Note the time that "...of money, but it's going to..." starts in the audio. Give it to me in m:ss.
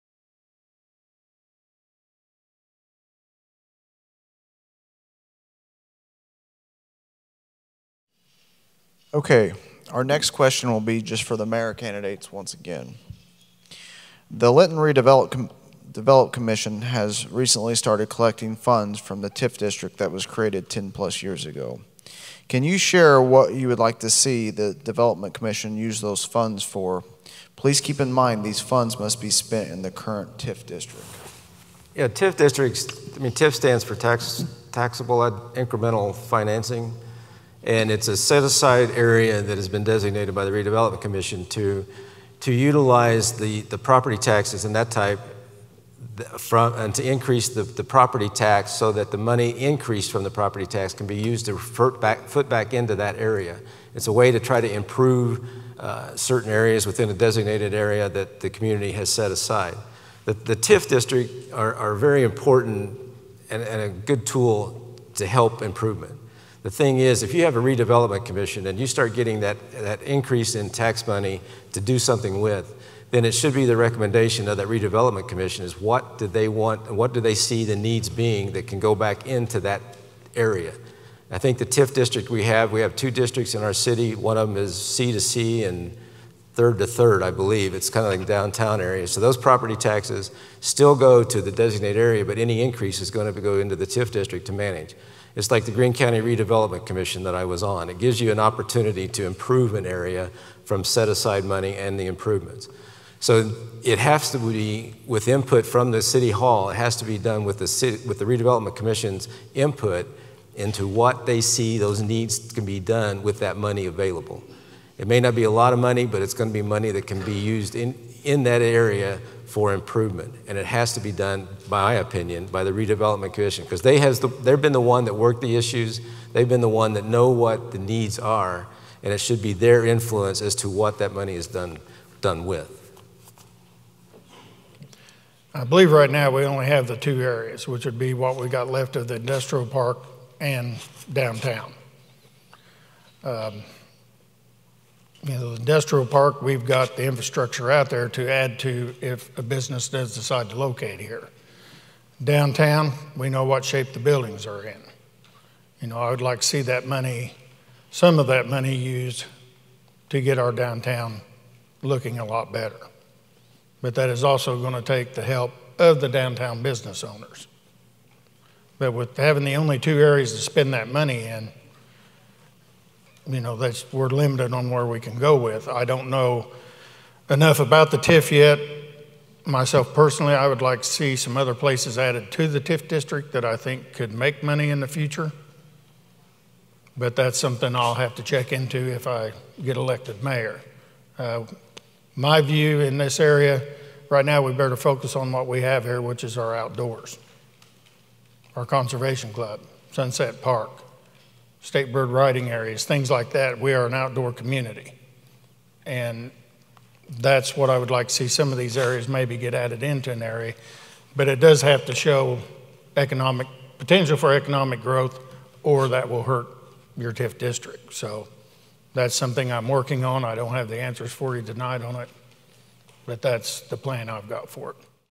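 1:55.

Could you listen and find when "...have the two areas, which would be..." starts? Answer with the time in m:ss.
2:16.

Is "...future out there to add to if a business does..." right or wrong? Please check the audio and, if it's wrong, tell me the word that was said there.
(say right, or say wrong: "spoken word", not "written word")
wrong: "infrastructure", not "future".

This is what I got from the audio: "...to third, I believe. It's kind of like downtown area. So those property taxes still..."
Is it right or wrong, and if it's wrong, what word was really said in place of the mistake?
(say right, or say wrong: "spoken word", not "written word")
right.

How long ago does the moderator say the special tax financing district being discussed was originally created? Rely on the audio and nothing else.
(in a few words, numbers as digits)
10 plus years ago.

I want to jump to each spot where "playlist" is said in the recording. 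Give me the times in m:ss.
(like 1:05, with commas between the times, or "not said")
not said.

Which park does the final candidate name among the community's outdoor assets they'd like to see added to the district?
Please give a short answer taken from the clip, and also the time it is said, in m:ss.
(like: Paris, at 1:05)
Sunset Park, at 3:19.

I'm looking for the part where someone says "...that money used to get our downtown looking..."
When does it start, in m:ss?
2:38.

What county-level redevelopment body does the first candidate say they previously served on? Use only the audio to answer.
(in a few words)
Greene County Redevelopment Commission.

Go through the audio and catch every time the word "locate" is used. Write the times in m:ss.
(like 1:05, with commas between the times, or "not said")
2:30.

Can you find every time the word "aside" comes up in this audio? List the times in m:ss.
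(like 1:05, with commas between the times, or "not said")
0:38, 0:59, 1:41.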